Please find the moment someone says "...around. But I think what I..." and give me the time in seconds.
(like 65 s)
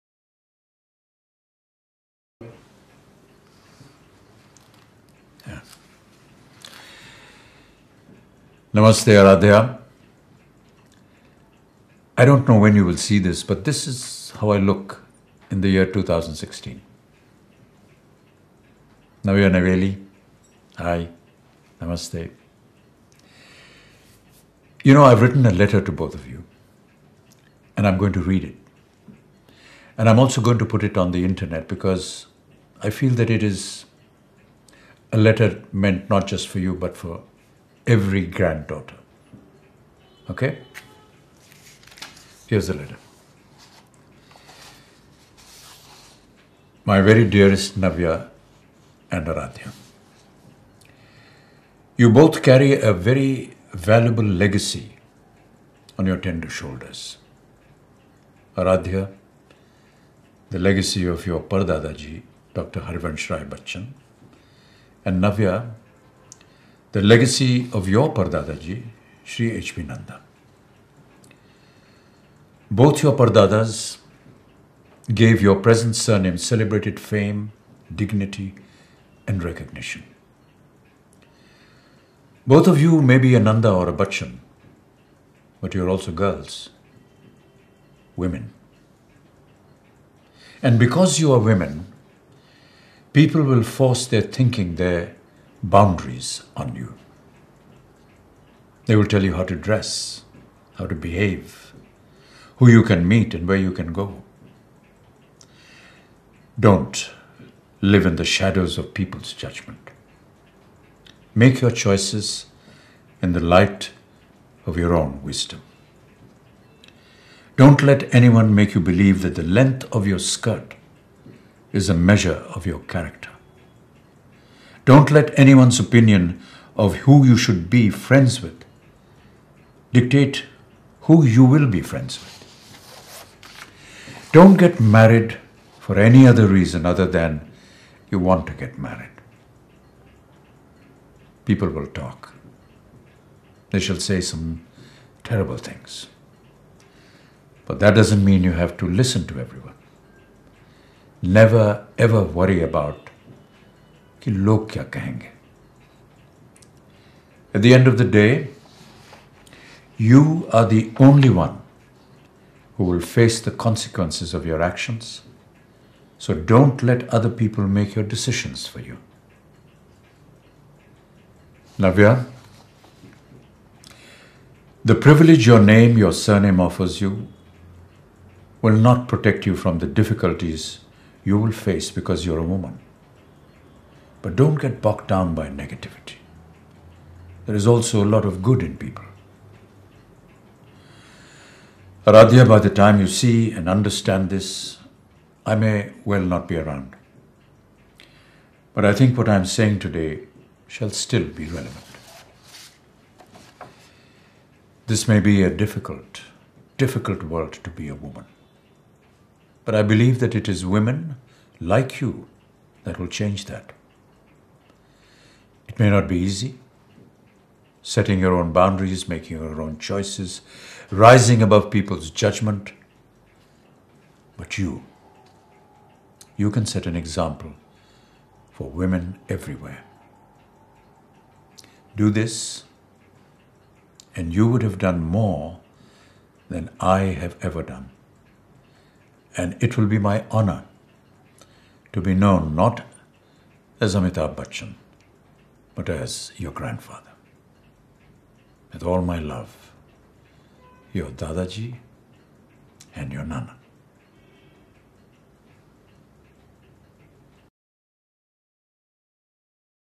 196 s.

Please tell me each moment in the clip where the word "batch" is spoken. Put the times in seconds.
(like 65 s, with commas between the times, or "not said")
not said.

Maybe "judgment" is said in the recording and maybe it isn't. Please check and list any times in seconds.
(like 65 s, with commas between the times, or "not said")
109 s, 222 s.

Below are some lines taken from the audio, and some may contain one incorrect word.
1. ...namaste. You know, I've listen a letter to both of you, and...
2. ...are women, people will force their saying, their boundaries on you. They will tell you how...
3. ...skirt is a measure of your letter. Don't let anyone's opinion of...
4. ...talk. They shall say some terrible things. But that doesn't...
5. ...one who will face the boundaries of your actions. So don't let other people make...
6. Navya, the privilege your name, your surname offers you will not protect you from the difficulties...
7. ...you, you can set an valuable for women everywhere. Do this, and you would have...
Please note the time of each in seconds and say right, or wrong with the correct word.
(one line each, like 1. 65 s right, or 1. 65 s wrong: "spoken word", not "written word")
1. 21 s wrong: "written", not "listen"
2. 91 s wrong: "thinking", not "saying"
3. 120 s wrong: "character", not "letter"
4. 141 s right
5. 161 s wrong: "consequences", not "boundaries"
6. 171 s right
7. 224 s wrong: "example", not "valuable".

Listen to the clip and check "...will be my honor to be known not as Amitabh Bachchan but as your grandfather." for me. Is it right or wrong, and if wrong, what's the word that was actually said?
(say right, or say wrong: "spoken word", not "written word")
right.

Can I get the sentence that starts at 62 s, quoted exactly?
Harivansh Rai Bachchan, and Navya, the legacy of your Pardadaji, Sri H.P.